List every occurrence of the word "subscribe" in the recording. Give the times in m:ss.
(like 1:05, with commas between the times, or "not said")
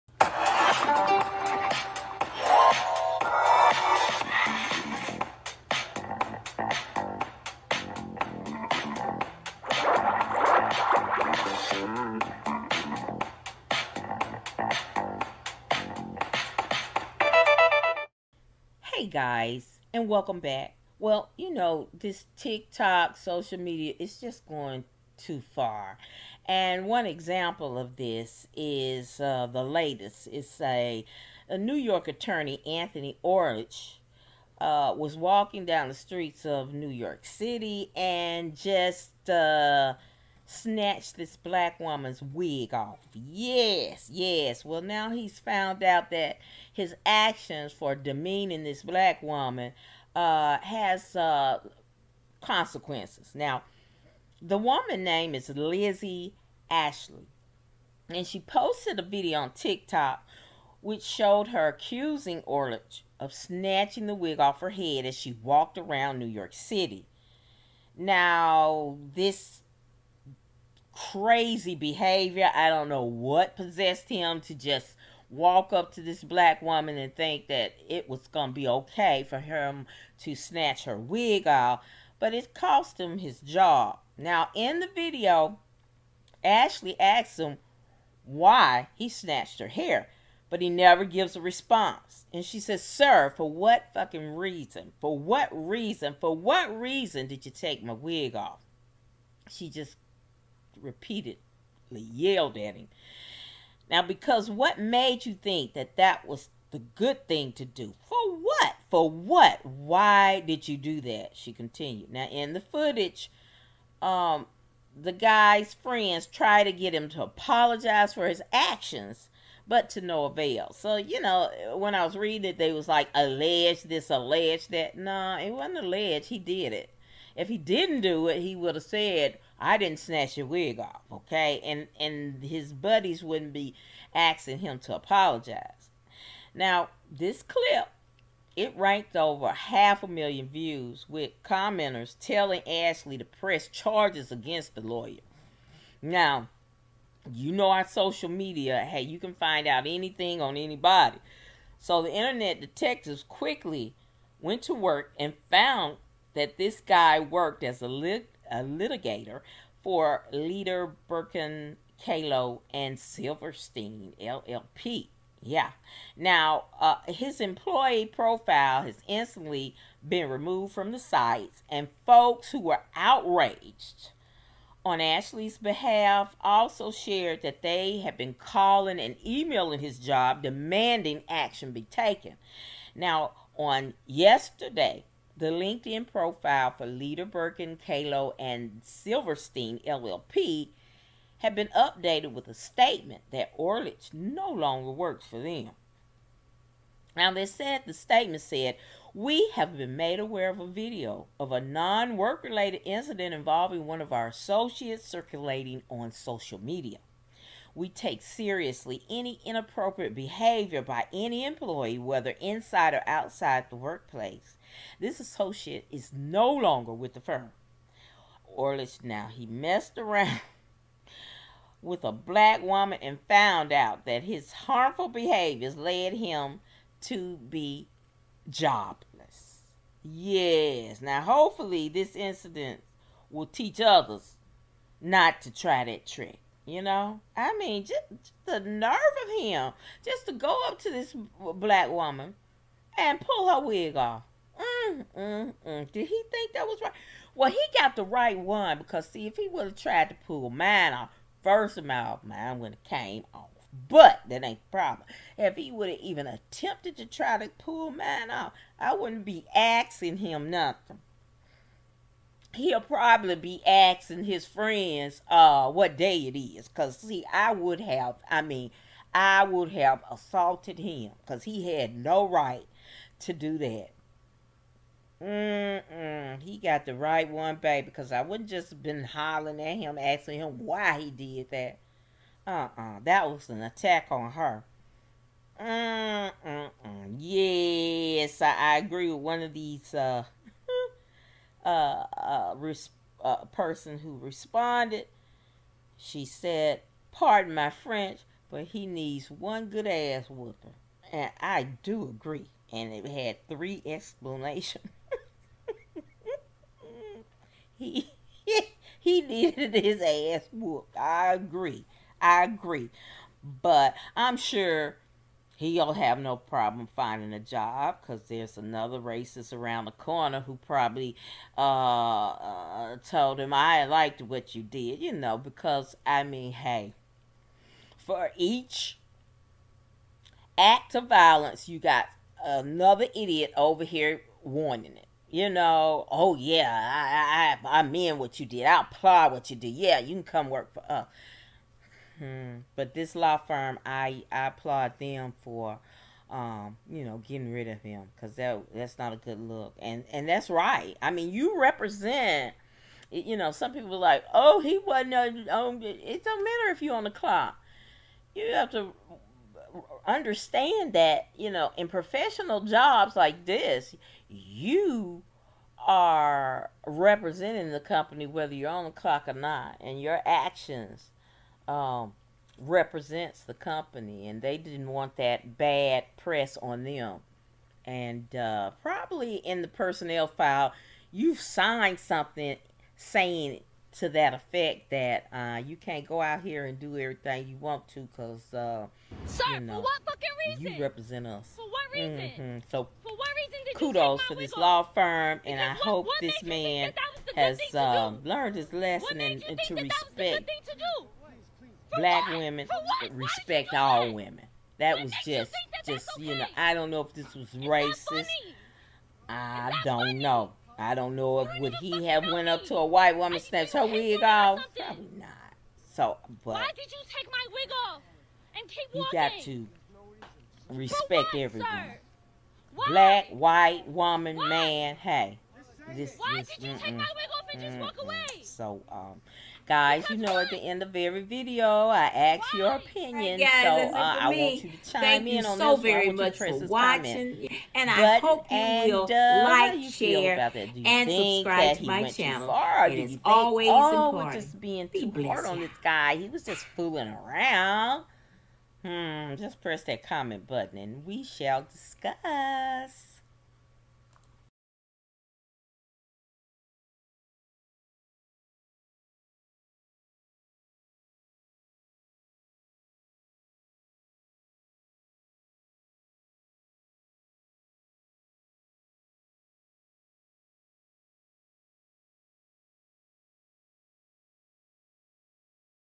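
7:21.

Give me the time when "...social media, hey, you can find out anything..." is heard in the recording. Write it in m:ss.
2:27.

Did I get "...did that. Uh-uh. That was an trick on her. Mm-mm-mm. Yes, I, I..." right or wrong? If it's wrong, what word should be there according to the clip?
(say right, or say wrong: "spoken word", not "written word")
wrong: "attack", not "trick".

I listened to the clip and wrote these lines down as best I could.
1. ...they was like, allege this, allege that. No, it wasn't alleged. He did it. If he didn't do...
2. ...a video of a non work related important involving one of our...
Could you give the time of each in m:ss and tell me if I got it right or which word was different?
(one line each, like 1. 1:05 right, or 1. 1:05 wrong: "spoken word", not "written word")
1. 2:02 right
2. 3:20 wrong: "incident", not "important".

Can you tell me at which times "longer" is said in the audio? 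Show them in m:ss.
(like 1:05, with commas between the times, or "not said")
3:14, 3:36.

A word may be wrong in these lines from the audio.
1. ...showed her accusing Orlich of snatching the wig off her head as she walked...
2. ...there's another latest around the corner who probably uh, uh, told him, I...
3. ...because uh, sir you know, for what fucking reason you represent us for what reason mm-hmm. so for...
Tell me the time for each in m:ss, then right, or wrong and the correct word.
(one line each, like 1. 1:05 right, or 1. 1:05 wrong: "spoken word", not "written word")
1. 1:01 right
2. 5:18 wrong: "racist", not "latest"
3. 6:28 right.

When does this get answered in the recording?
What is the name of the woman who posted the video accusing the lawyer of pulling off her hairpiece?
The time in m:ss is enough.
0:55.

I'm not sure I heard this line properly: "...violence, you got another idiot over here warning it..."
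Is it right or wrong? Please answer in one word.
right.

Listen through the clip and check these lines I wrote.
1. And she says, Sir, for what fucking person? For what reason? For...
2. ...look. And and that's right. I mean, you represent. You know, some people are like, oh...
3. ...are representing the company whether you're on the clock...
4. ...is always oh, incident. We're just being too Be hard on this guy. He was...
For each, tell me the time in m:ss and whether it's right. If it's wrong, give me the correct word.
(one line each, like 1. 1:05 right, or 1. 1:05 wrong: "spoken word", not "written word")
1. 1:32 wrong: "reason", not "person"
2. 5:49 right
3. 6:05 right
4. 7:22 wrong: "important", not "incident".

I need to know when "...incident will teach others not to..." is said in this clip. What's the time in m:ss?
3:52.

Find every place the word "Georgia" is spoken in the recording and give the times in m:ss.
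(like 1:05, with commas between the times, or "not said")
not said.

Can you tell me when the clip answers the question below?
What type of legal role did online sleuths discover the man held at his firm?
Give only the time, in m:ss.
2:38.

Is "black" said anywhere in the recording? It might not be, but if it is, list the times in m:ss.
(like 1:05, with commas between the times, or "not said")
0:41, 0:48, 1:16, 3:42, 4:01, 6:41, 7:02.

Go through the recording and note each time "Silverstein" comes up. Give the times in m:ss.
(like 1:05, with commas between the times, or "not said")
2:42, 3:08.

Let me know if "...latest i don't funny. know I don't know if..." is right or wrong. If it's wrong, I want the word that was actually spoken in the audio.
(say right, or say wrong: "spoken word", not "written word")
wrong: "racist", not "latest".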